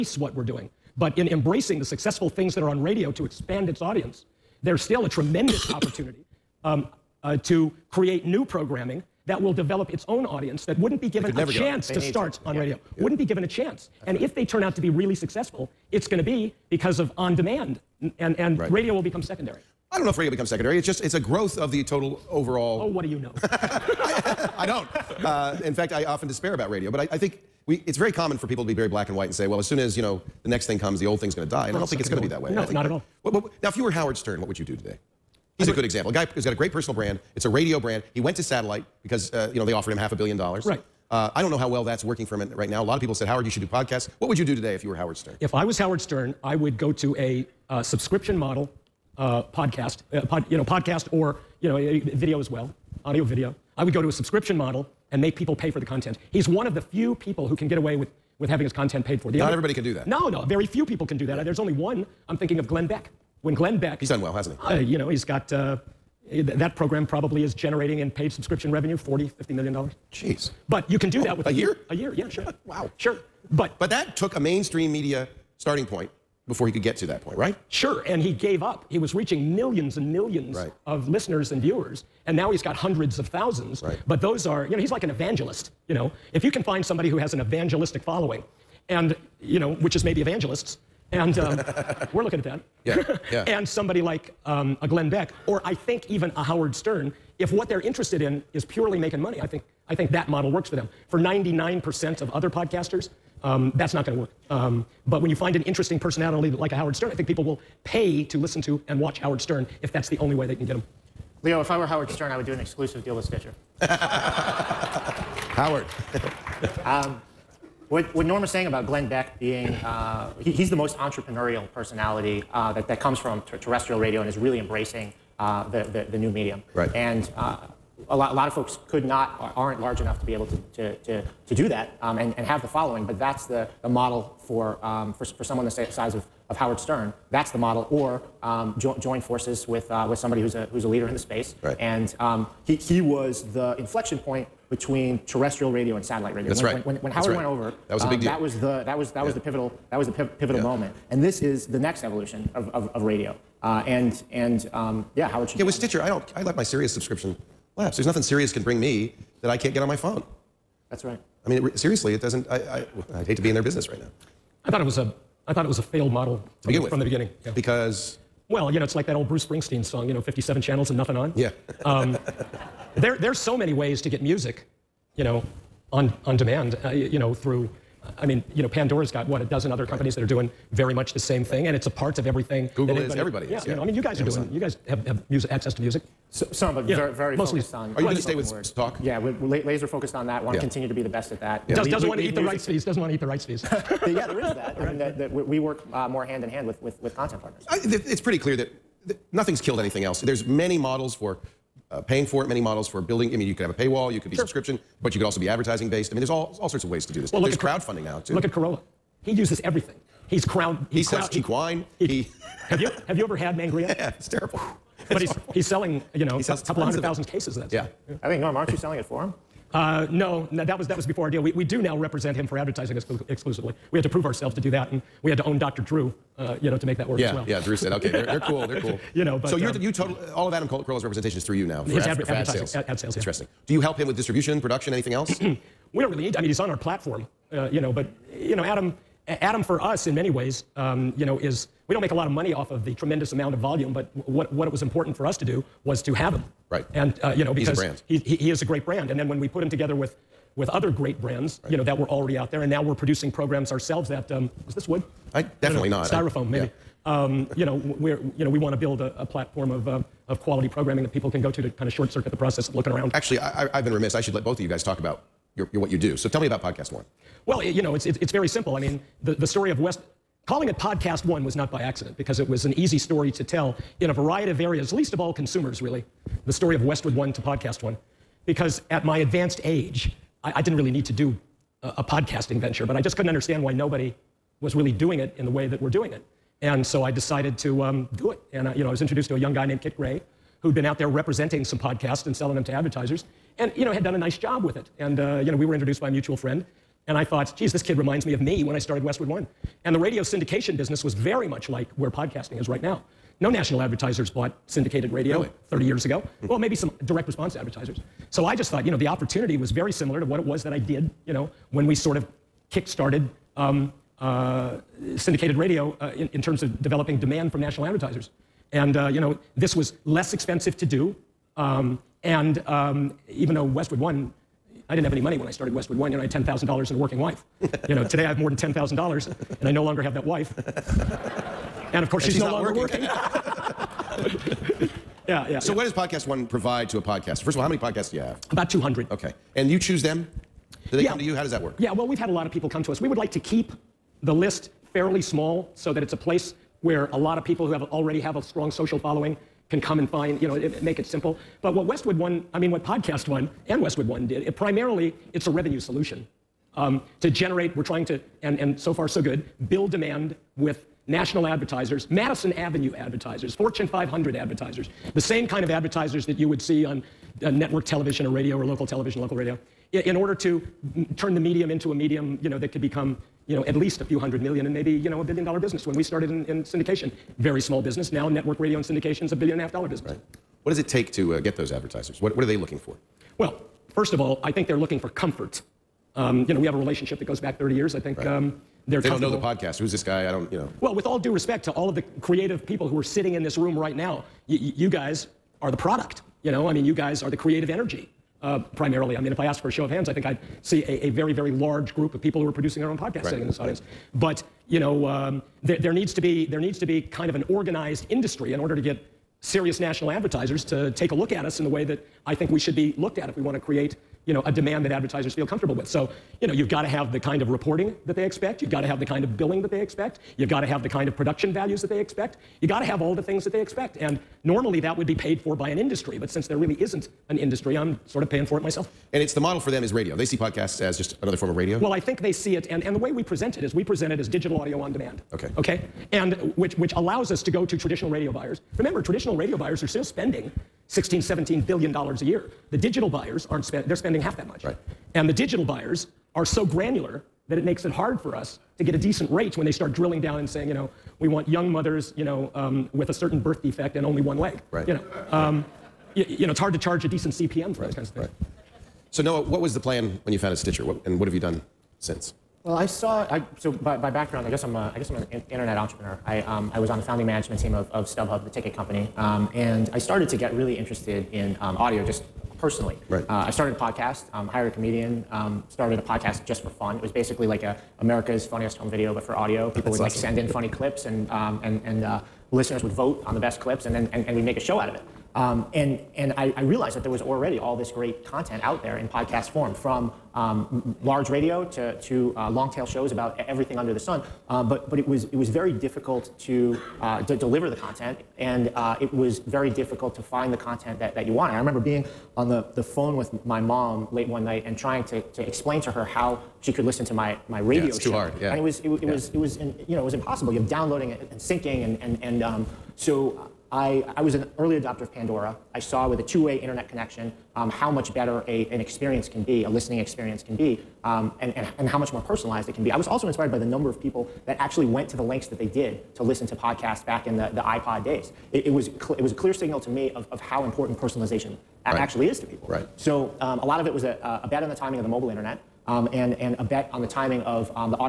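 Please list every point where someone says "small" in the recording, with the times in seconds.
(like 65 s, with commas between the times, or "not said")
345 s, 377 s.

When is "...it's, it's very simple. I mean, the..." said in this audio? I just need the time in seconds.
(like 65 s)
268 s.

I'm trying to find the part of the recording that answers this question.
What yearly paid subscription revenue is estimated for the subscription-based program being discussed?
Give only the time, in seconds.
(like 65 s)
68 s.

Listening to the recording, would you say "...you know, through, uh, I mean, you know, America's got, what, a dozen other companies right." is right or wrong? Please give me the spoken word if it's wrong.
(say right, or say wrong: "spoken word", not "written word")
wrong: "Pandora", not "America".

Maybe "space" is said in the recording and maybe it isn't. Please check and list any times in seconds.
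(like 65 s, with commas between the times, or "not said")
141 s.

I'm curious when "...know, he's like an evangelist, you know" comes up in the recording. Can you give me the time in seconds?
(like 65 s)
84 s.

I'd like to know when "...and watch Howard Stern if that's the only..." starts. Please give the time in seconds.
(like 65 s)
108 s.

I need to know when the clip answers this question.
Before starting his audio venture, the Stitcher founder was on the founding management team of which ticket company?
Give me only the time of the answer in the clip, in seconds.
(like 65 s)
468 s.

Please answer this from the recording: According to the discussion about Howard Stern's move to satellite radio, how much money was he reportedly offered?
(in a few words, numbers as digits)
half a billion dollars.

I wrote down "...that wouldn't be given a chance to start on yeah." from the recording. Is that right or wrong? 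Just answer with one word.
right.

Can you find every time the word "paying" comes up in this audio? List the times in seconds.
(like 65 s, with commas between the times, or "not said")
202 s, 428 s.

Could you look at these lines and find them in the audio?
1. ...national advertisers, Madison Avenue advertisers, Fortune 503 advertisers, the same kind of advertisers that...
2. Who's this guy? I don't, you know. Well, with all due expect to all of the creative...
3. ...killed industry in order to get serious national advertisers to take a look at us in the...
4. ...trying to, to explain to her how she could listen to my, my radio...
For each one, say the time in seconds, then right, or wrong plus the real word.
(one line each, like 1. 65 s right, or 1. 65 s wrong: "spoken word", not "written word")
1. 361 s wrong: "500", not "503"
2. 389 s wrong: "respect", not "expect"
3. 407 s wrong: "organized", not "killed"
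4. 504 s right.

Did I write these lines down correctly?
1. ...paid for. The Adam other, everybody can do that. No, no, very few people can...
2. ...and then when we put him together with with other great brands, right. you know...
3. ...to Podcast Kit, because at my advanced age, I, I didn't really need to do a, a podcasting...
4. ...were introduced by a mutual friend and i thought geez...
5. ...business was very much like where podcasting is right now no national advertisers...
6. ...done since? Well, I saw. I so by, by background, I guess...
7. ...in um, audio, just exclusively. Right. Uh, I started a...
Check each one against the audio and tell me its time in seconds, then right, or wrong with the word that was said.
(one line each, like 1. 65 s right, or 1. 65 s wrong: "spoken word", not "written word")
1. 59 s wrong: "Not", not "Adam"
2. 249 s right
3. 277 s wrong: "One", not "Kit"
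4. 295 s right
5. 300 s right
6. 461 s right
7. 471 s wrong: "personally", not "exclusively".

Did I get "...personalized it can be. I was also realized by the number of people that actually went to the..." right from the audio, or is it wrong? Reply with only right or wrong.
wrong.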